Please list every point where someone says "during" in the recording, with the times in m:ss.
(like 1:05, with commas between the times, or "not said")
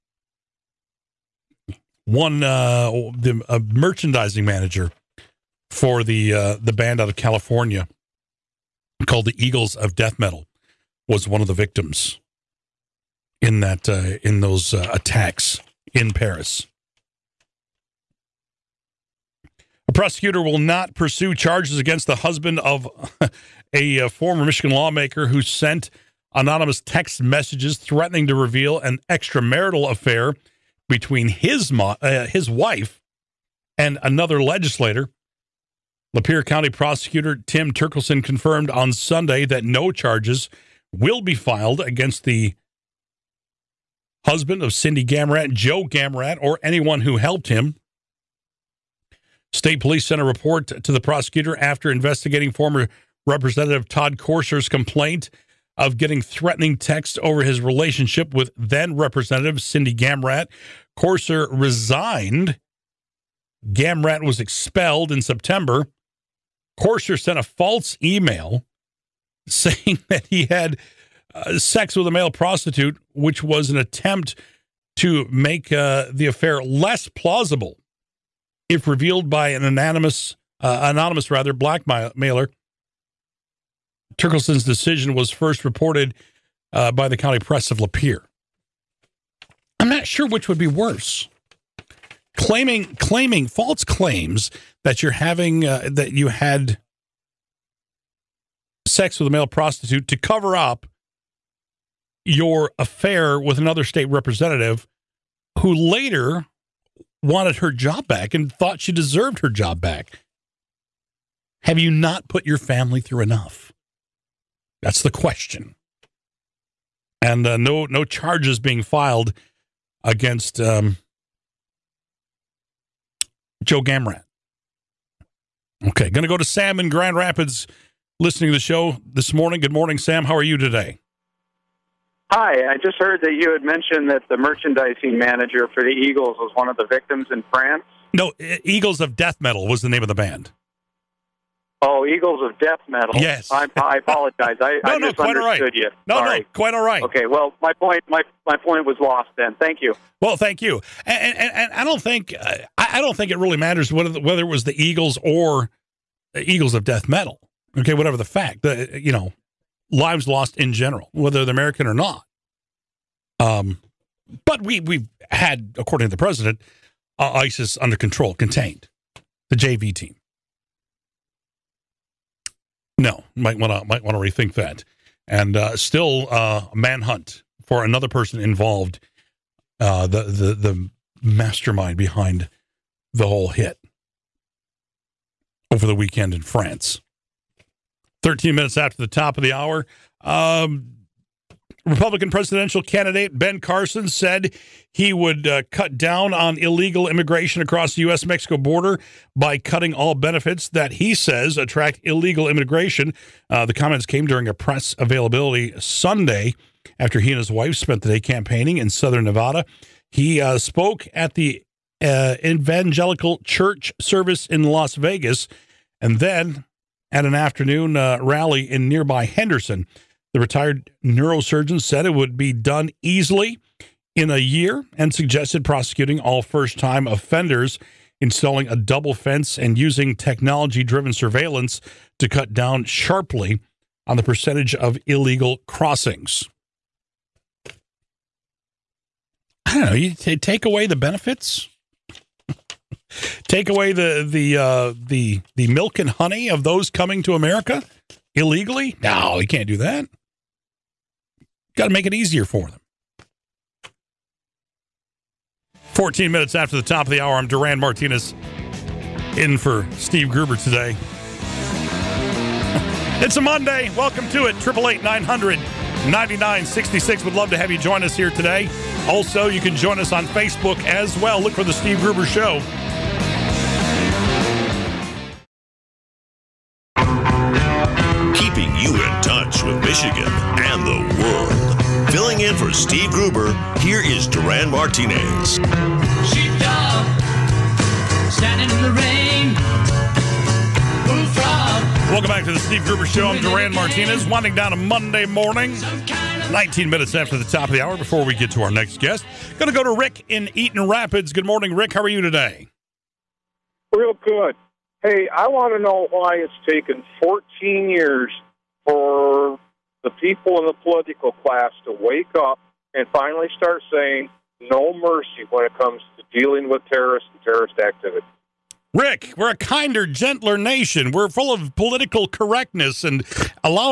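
3:24.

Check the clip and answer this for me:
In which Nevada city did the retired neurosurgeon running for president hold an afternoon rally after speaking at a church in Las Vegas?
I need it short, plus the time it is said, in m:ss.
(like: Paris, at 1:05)
Henderson, at 3:39.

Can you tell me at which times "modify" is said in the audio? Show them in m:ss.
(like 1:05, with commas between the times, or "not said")
not said.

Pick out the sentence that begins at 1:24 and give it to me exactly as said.
Turkelson's decision was first reported uh, by the county press of Lapeer.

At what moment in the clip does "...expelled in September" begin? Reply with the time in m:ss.
1:04.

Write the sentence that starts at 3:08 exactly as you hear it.
Thirteen minutes after the top of the hour.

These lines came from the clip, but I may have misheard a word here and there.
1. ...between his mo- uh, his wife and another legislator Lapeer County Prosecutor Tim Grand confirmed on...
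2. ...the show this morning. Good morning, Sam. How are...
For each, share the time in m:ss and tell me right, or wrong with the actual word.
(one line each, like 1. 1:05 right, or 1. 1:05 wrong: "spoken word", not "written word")
1. 0:30 wrong: "Turkelson", not "Grand"
2. 2:08 right.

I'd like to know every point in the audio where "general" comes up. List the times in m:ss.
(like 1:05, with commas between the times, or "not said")
2:40.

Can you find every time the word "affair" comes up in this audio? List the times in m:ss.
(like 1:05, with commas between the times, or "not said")
0:29, 1:16, 1:42.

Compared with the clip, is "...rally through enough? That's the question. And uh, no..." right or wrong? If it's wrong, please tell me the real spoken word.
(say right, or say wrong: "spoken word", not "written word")
wrong: "family", not "rally".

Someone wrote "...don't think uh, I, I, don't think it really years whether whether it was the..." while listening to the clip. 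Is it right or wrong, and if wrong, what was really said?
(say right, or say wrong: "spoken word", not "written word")
wrong: "matters", not "years".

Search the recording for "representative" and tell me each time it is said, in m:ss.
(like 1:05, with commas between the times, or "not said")
0:53, 0:58, 1:44.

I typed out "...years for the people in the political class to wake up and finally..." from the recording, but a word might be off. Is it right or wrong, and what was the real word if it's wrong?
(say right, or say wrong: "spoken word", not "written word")
right.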